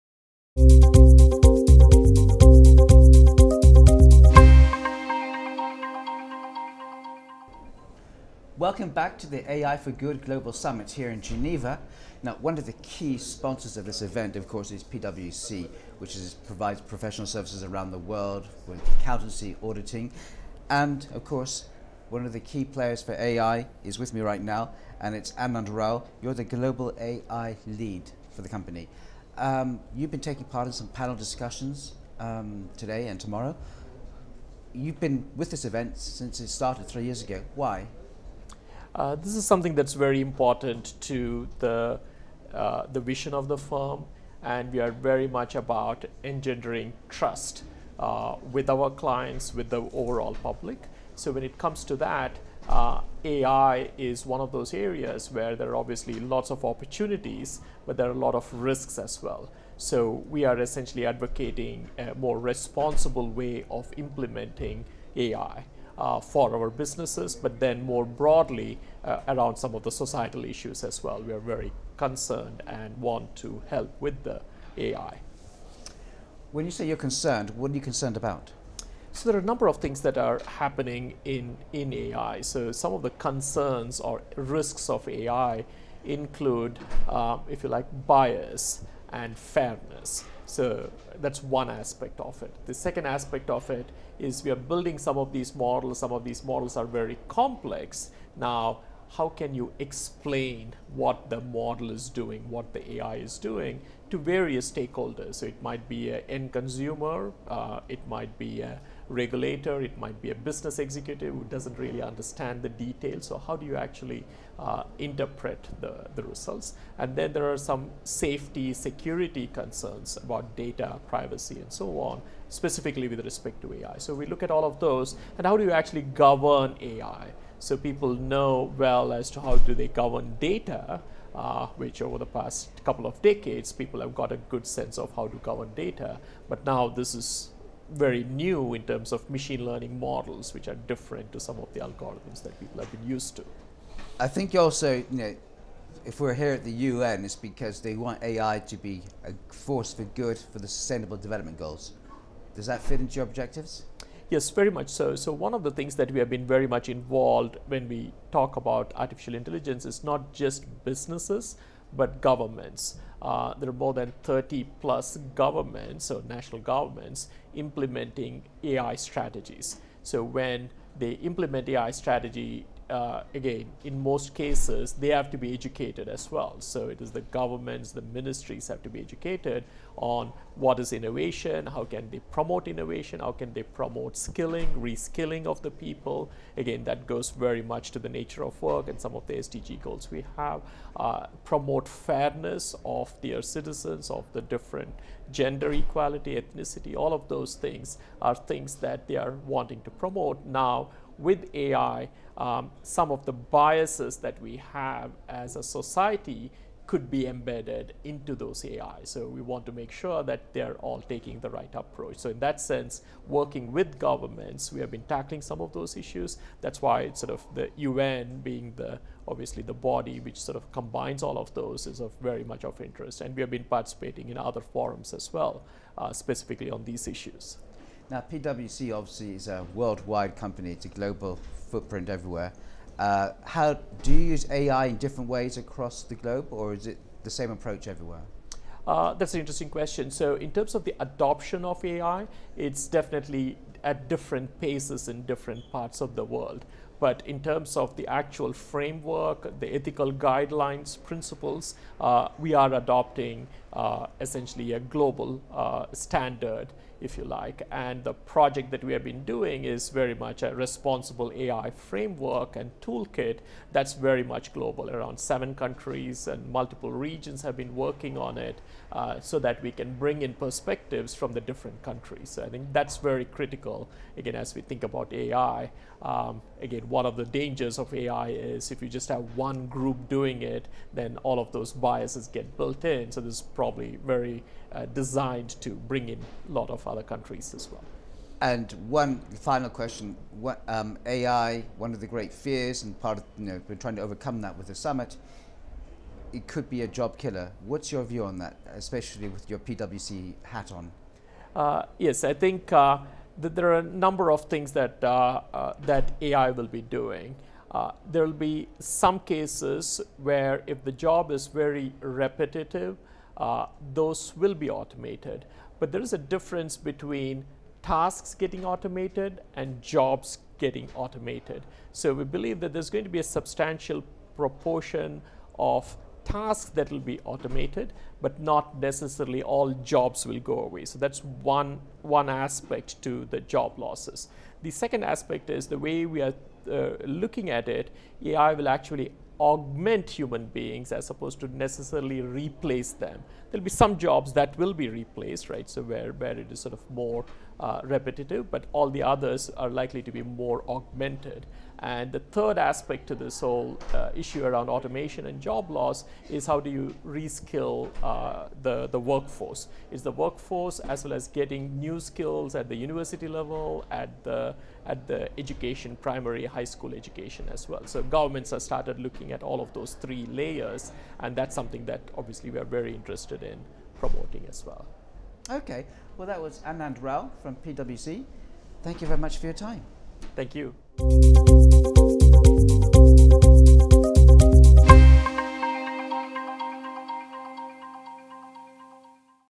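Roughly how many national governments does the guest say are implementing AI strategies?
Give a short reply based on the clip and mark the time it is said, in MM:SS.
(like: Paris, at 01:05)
30 plus, at 02:44.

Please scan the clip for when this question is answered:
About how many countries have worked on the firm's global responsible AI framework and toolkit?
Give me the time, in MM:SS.
04:25.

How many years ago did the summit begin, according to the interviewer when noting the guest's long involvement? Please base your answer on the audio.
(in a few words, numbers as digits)
3.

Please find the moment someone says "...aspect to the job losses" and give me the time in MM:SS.
05:32.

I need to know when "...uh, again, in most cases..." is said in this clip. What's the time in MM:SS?
02:52.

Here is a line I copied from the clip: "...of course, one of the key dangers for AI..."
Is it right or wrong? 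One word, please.
wrong.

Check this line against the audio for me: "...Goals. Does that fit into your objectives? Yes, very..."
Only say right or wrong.
right.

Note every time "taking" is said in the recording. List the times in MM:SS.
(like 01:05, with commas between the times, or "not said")
00:30, 03:30.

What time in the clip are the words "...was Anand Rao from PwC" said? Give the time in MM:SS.
06:16.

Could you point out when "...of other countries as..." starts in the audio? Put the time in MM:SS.
04:46.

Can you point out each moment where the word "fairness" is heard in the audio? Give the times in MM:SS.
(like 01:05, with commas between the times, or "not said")
01:29, 03:11.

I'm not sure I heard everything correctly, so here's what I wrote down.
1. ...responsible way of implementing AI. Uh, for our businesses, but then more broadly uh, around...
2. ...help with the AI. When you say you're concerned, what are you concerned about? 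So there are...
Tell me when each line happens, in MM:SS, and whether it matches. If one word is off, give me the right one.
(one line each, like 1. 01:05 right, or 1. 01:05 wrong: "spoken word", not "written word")
1. 01:02 right
2. 01:13 right.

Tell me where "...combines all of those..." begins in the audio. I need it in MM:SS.
03:40.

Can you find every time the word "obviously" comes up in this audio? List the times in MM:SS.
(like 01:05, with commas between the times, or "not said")
00:55, 03:39, 03:48, 06:12.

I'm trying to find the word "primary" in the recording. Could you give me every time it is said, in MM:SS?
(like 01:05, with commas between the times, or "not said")
06:06.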